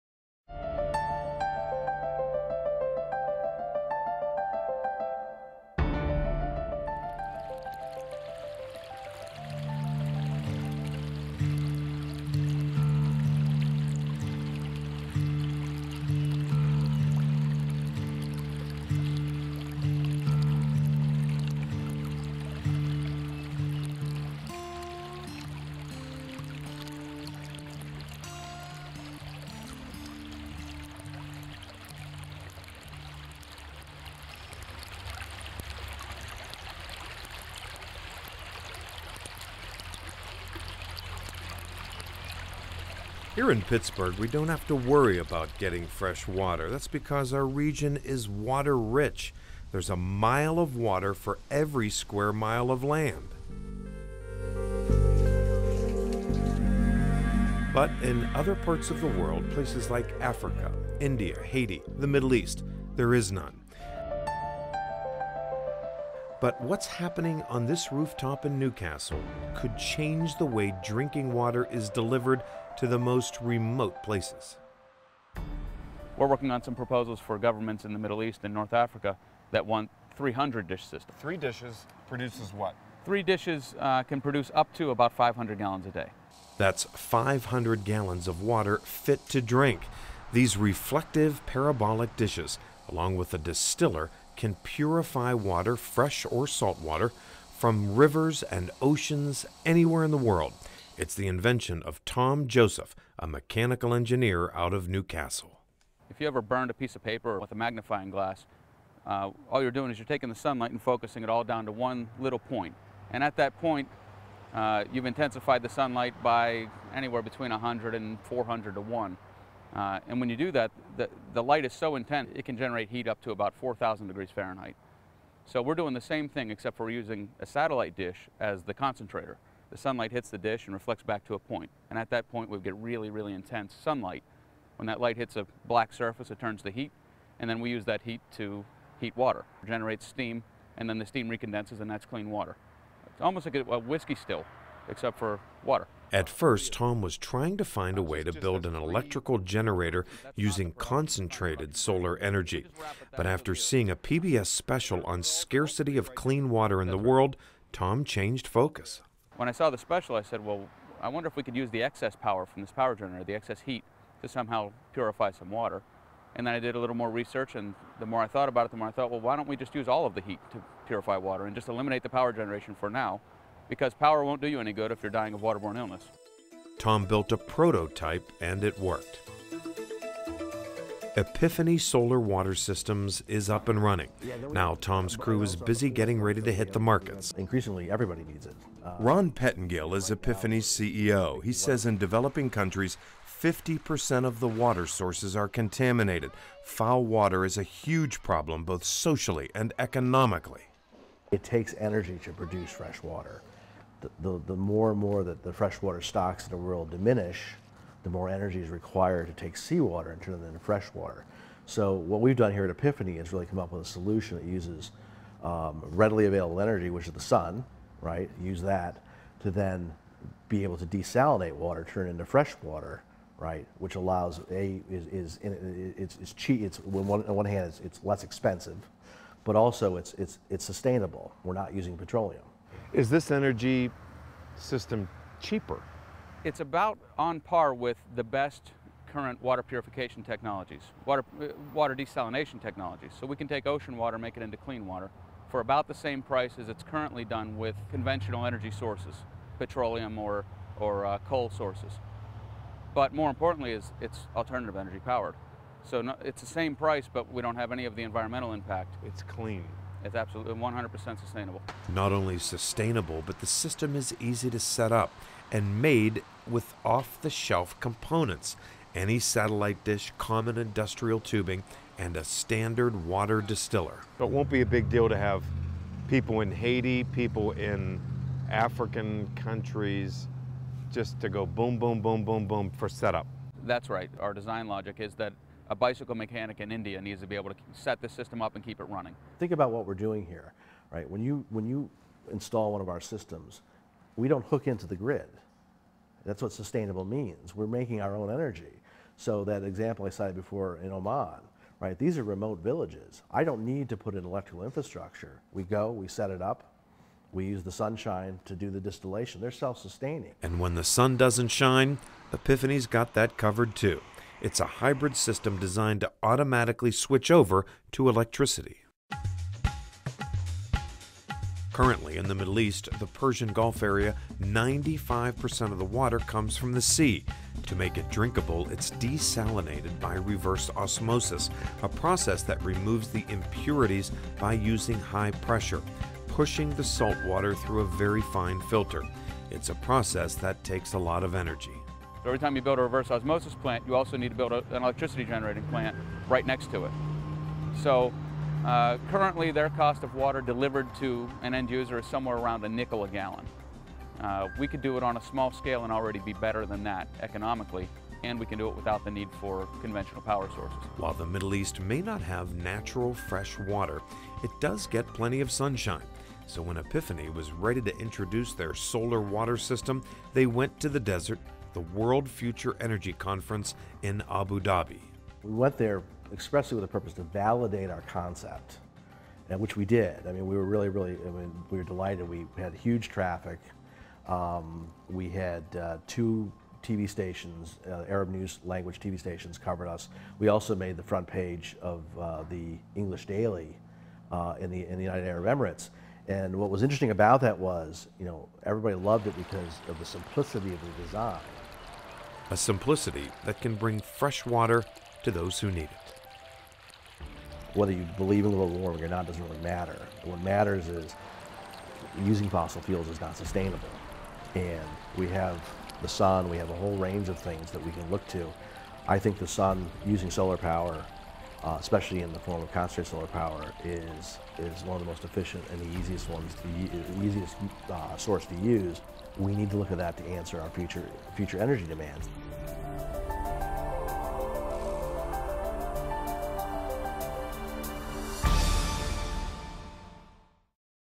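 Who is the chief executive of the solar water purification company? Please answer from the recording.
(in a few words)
Ron Pettingill.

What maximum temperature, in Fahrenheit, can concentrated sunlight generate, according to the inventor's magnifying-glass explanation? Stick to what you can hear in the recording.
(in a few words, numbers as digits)
4,000 degrees.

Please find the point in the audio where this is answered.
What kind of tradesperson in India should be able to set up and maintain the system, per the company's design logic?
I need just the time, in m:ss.
4:45.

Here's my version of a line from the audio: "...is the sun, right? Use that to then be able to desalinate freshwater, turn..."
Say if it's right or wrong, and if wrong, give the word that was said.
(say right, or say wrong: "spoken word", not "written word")
wrong: "water", not "freshwater".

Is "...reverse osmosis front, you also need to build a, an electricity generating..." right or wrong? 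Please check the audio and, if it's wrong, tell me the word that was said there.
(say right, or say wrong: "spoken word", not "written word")
wrong: "plant", not "front".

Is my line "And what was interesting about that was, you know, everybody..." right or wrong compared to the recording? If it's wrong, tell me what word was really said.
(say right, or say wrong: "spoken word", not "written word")
right.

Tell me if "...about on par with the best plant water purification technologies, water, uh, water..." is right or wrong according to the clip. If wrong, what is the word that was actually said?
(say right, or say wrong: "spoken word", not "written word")
wrong: "current", not "plant".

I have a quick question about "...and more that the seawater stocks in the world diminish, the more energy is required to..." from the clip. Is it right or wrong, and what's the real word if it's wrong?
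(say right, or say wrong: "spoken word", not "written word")
wrong: "freshwater", not "seawater".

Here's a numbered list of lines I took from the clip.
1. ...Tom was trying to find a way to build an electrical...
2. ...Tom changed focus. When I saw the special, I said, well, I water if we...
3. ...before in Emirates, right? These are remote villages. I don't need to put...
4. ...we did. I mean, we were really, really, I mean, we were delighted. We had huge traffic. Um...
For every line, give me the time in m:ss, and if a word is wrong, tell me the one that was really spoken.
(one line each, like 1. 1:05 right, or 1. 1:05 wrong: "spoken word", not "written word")
1. 2:26 right
2. 2:37 wrong: "wonder", not "water"
3. 5:00 wrong: "Oman", not "Emirates"
4. 6:19 right.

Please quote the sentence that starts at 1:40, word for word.
It's the invention of Tom Joseph, a mechanical engineer out of New Castle.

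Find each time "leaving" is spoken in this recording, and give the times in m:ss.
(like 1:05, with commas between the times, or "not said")
not said.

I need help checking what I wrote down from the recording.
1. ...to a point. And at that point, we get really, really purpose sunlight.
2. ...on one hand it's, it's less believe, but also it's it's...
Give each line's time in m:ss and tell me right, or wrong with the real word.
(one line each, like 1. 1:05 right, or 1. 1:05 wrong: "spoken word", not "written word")
1. 2:11 wrong: "intense", not "purpose"
2. 3:47 wrong: "expensive", not "believe".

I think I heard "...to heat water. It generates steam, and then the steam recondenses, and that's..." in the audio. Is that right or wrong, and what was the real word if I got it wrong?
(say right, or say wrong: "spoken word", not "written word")
right.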